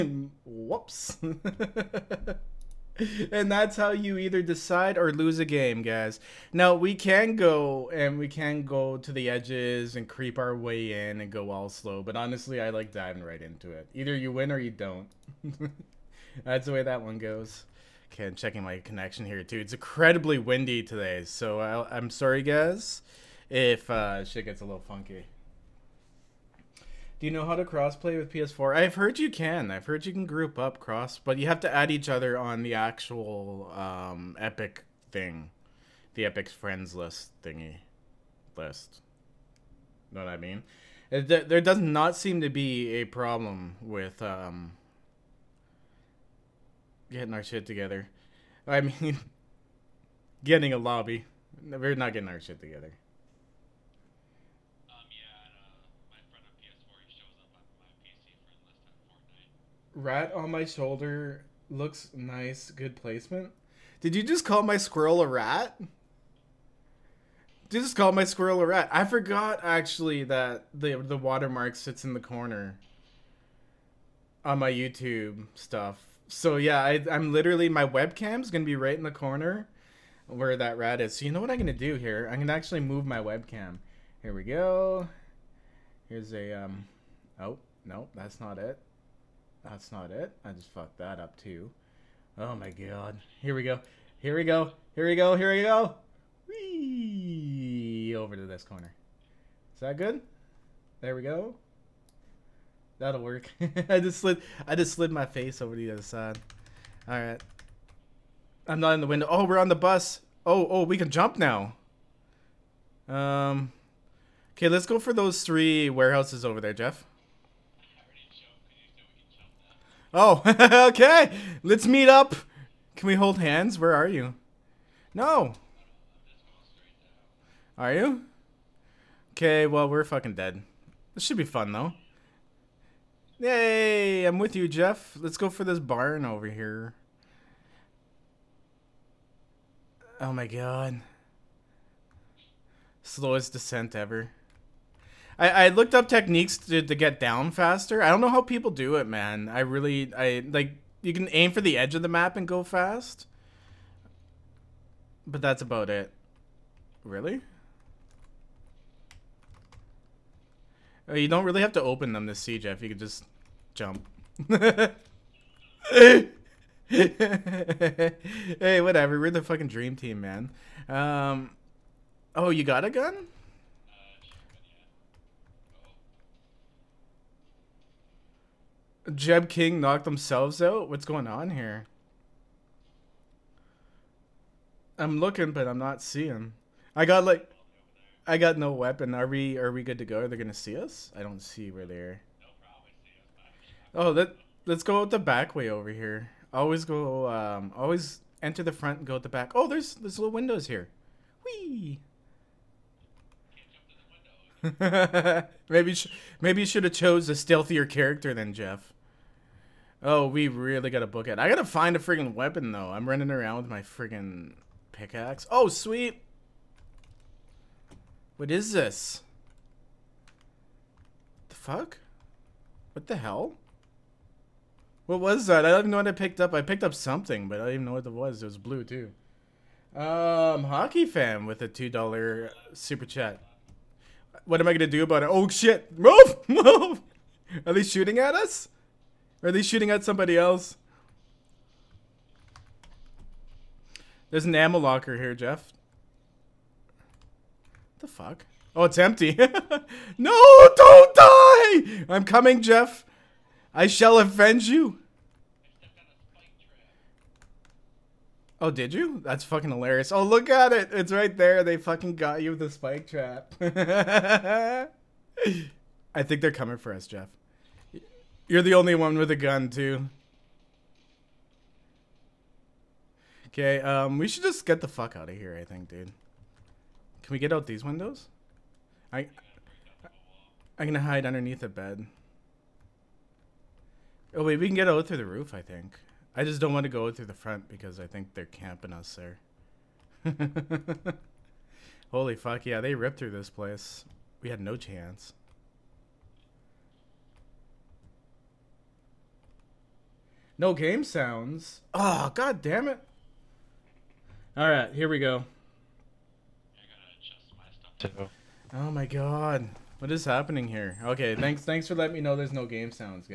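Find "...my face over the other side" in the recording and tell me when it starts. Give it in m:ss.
1:45.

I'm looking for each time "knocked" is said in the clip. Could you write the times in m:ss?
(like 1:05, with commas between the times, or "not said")
2:59.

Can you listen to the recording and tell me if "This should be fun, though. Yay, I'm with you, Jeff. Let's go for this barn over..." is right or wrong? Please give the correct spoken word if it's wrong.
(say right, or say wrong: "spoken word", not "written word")
right.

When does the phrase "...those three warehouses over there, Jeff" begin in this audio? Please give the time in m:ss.
1:55.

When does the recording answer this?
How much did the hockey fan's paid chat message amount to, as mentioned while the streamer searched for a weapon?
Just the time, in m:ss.
3:51.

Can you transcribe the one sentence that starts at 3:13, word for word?
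Oh, that let's go out the back way over here.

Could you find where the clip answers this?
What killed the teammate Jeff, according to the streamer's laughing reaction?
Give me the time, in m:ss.
4:22.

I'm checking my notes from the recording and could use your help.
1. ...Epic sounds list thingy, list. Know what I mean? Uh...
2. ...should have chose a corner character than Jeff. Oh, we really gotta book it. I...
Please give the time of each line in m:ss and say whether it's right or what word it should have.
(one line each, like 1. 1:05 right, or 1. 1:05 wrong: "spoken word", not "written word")
1. 0:36 wrong: "friends", not "sounds"
2. 3:26 wrong: "stealthier", not "corner".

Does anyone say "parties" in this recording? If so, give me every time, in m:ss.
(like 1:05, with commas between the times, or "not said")
not said.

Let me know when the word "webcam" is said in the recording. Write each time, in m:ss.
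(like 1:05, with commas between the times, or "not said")
1:17, 1:23.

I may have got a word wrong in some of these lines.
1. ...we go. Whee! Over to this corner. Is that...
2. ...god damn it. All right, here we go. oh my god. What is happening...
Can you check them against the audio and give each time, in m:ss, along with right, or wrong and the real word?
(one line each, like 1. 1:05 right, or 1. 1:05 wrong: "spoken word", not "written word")
1. 1:35 right
2. 5:02 right.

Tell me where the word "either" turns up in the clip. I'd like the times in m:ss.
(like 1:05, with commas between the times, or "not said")
0:04, 0:13.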